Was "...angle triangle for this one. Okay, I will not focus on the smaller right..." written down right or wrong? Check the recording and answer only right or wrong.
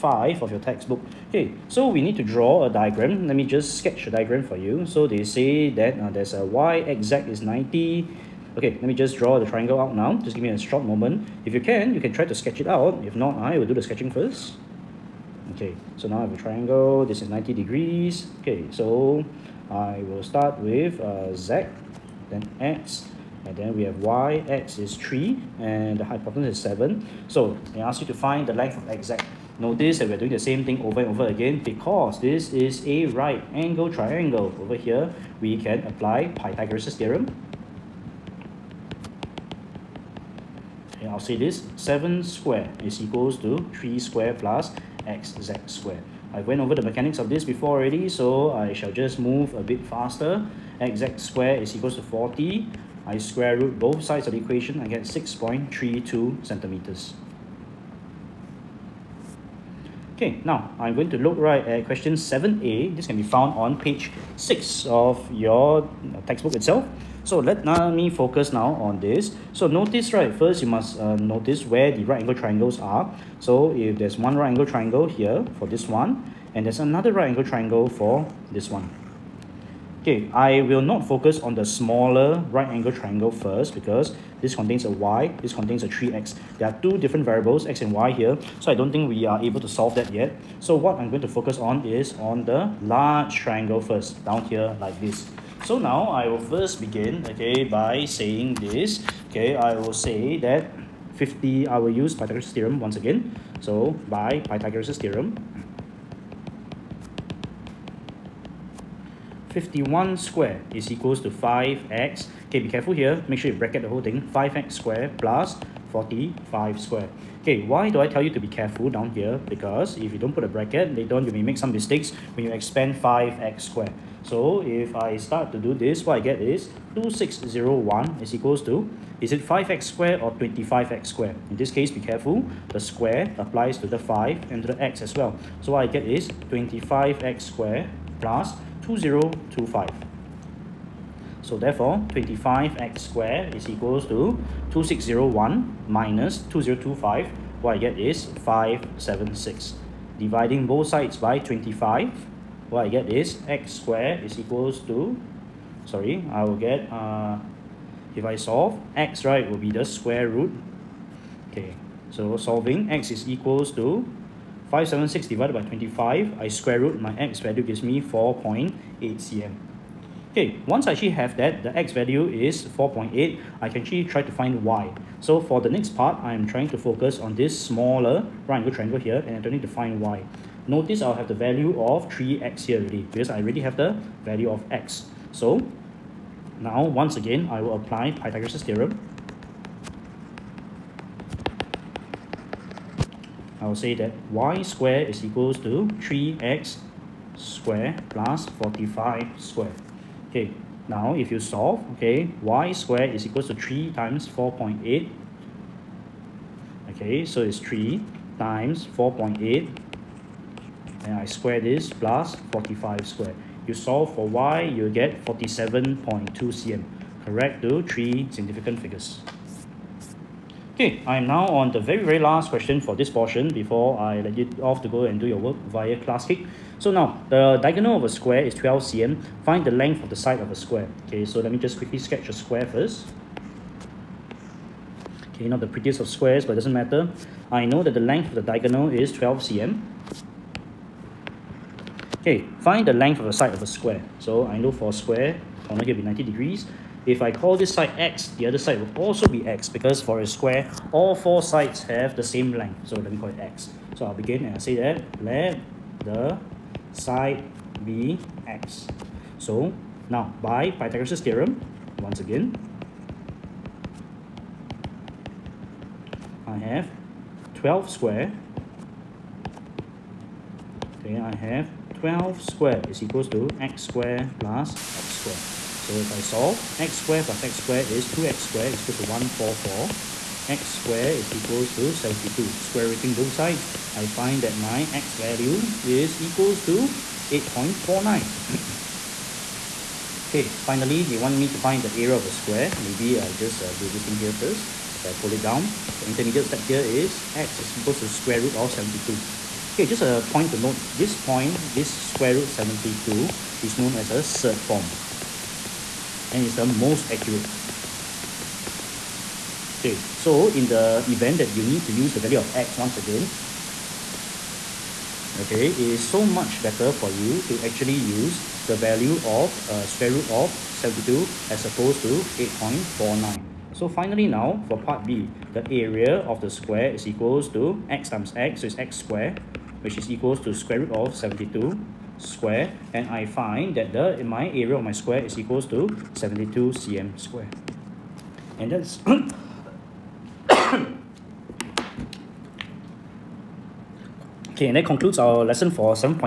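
right.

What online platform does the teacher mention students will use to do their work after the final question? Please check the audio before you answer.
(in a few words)
Classkick.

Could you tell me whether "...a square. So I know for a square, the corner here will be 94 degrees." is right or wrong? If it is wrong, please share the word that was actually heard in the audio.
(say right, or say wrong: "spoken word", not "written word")
wrong: "90", not "94".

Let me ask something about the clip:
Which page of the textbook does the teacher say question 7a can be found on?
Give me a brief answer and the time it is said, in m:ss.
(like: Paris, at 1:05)
page 6, at 1:03.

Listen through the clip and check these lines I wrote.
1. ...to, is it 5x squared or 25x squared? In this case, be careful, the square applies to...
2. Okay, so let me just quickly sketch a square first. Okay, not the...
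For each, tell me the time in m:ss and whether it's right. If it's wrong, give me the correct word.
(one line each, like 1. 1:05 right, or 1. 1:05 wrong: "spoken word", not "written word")
1. 2:08 right
2. 3:51 right.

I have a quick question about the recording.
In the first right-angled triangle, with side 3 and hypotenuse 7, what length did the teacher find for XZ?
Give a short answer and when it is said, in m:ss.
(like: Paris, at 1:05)
6.32 centimeters, at 0:55.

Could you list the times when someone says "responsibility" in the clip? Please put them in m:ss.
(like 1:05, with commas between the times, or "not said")
not said.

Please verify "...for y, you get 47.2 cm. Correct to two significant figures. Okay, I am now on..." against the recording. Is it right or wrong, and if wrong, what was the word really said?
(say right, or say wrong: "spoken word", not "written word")
wrong: "three", not "two".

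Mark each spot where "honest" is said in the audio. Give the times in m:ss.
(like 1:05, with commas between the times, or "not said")
not said.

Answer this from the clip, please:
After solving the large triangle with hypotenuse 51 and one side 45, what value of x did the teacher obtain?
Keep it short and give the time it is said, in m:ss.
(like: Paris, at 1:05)
4.8 cm, at 2:48.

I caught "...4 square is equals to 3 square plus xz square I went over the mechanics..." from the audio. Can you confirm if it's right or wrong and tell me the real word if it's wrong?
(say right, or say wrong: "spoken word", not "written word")
wrong: "7", not "4".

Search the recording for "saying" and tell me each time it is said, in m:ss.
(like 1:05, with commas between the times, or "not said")
1:38.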